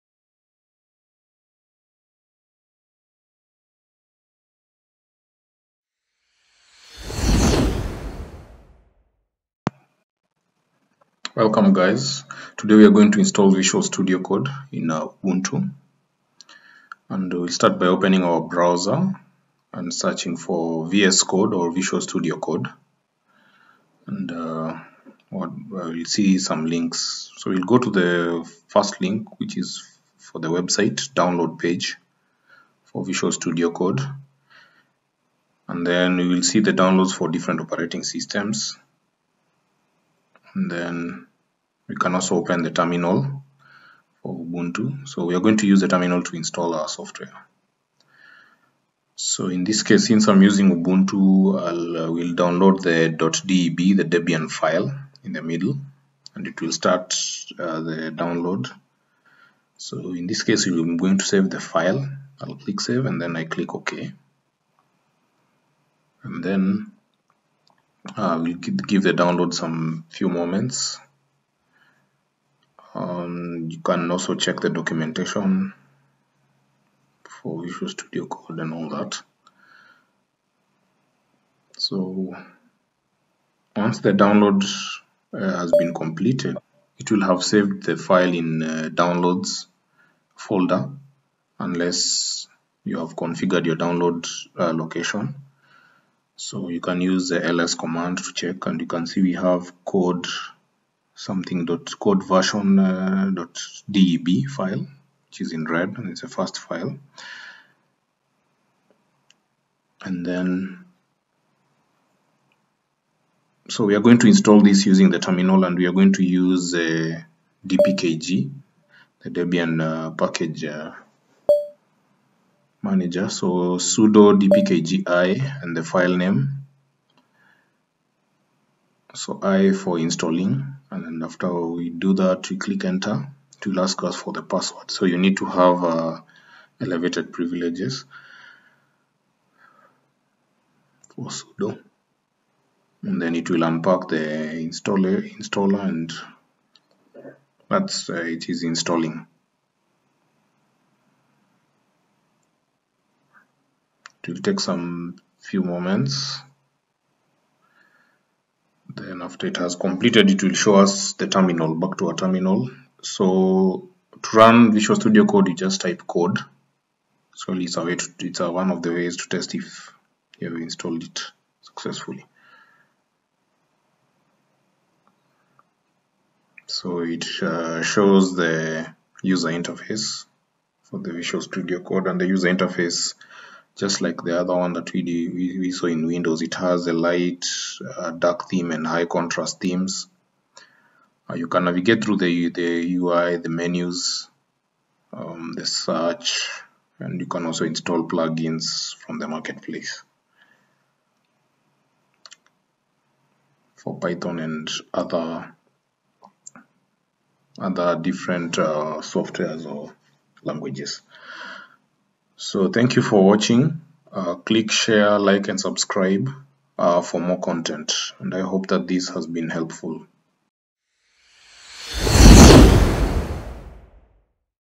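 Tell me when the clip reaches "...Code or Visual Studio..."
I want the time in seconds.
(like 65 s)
21 s.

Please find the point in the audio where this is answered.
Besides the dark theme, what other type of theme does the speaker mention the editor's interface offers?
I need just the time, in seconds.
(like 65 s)
188 s.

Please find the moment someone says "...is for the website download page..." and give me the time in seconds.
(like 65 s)
29 s.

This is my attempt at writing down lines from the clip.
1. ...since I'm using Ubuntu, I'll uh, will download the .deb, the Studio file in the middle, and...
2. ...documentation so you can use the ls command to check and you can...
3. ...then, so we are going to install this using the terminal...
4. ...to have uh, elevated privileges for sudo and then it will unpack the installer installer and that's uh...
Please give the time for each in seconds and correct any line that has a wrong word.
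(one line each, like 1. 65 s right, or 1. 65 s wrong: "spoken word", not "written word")
1. 50 s wrong: "Debian", not "Studio"
2. 94 s wrong: "location", not "documentation"
3. 110 s right
4. 135 s right.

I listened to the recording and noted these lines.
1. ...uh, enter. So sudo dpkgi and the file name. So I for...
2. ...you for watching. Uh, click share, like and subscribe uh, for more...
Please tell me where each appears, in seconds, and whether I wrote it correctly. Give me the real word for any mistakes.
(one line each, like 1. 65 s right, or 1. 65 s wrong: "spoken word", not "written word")
1. 120 s wrong: "manager", not "enter"
2. 212 s right.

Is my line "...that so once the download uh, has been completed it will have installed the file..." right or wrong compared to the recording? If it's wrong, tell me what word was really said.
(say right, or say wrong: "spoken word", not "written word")
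wrong: "saved", not "installed".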